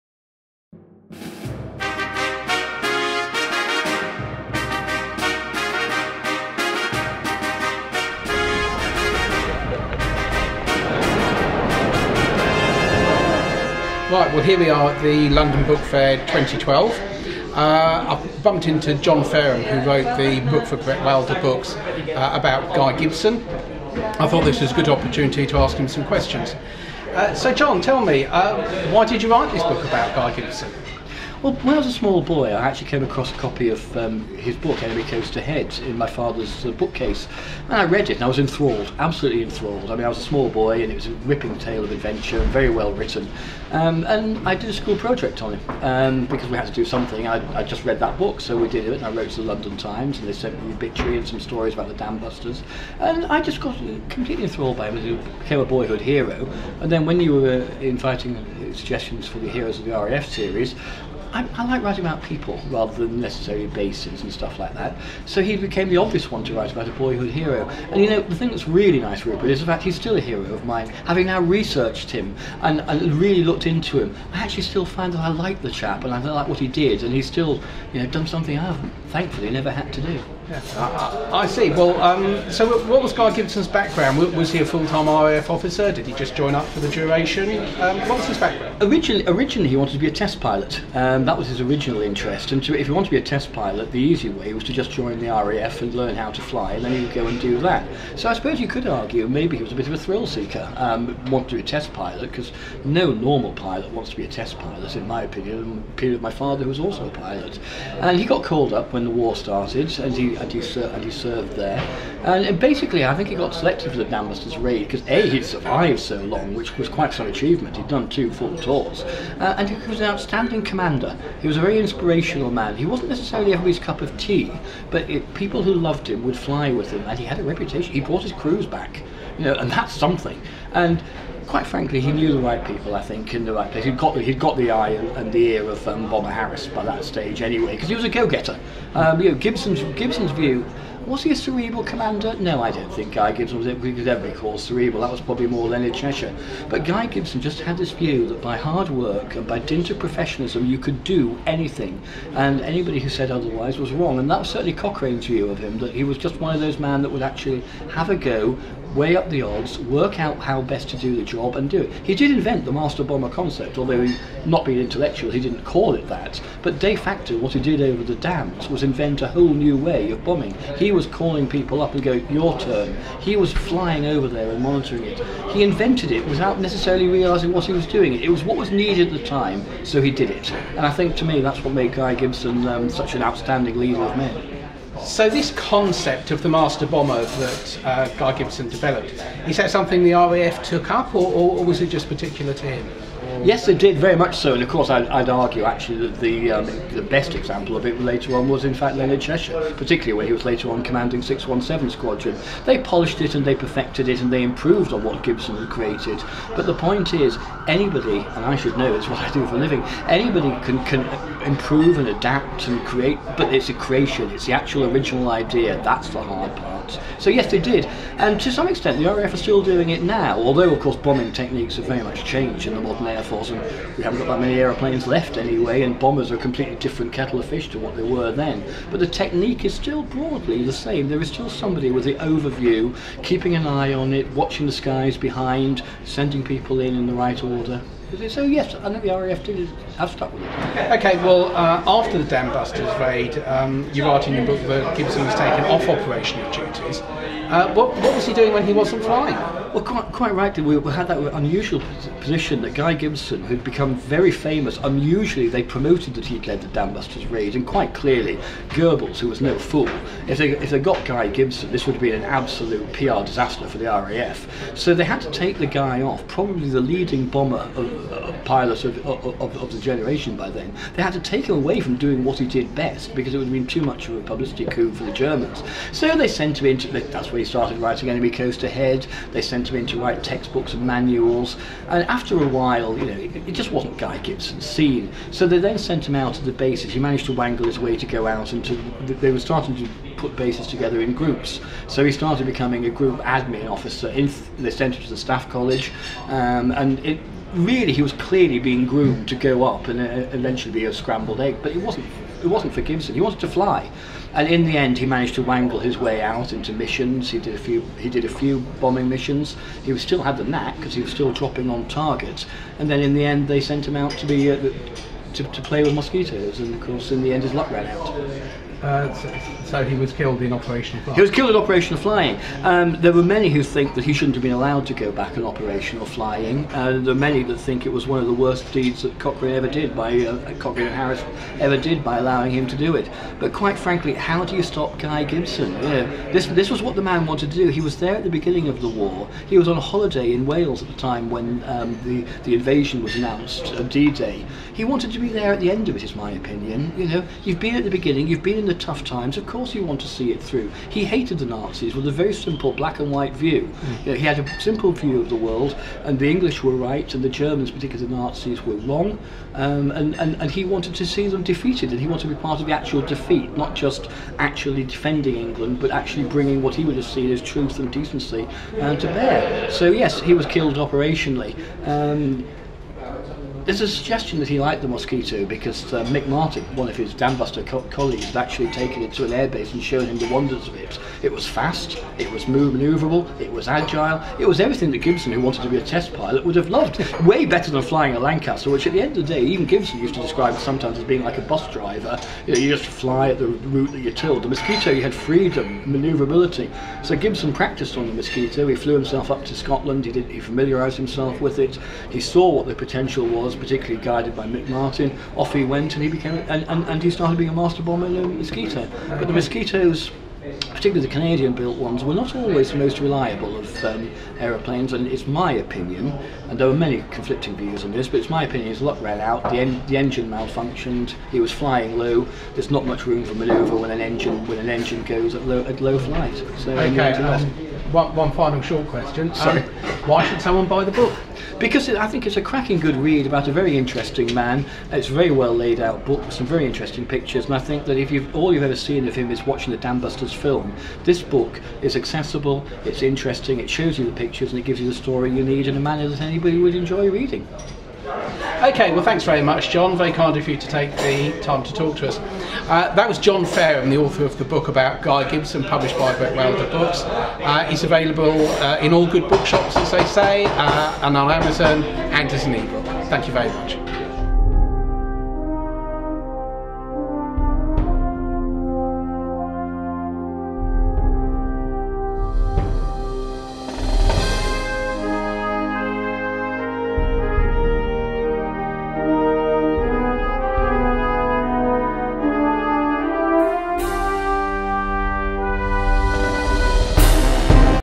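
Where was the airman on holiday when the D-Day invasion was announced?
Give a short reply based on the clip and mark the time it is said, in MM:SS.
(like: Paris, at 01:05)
Wales, at 05:40.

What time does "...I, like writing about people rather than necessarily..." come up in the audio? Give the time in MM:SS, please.
01:01.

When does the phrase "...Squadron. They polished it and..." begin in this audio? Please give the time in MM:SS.
03:21.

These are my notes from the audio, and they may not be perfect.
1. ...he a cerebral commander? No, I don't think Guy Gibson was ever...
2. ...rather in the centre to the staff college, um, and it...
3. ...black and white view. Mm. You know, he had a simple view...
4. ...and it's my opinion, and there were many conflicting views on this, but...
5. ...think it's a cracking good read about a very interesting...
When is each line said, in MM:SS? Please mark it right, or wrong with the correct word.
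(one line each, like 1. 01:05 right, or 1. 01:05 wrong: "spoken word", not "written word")
1. 02:21 right
2. 04:53 wrong: "officer", not "rather"
3. 05:52 right
4. 06:54 right
5. 07:12 right.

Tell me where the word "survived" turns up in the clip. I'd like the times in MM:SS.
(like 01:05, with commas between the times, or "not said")
01:55.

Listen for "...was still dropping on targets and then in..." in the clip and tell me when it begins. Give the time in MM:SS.
05:11.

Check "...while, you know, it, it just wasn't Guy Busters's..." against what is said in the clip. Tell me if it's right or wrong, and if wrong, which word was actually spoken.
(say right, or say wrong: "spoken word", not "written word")
wrong: "Gibson", not "Busters".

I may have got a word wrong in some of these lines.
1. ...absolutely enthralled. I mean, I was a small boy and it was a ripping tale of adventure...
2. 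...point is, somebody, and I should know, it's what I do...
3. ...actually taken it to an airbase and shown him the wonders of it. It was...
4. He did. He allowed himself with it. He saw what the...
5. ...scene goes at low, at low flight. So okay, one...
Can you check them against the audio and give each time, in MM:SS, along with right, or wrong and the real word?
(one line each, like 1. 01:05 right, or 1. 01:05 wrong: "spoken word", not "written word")
1. 00:38 right
2. 03:26 wrong: "anybody", not "somebody"
3. 06:18 right
4. 06:40 wrong: "familiarised", not "allowed"
5. 07:04 wrong: "engine", not "scene".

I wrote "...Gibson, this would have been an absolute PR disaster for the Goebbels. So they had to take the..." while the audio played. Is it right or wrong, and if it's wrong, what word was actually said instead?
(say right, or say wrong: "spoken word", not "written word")
wrong: "RAF", not "Goebbels".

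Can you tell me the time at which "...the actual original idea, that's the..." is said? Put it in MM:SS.
03:34.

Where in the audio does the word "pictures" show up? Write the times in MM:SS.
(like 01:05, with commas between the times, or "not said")
07:17, 07:24.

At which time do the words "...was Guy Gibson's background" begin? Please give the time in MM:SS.
01:23.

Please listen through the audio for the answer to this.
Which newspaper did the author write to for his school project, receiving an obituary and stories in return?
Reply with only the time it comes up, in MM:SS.
00:49.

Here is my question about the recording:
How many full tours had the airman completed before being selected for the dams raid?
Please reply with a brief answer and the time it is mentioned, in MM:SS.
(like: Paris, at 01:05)
2, at 01:58.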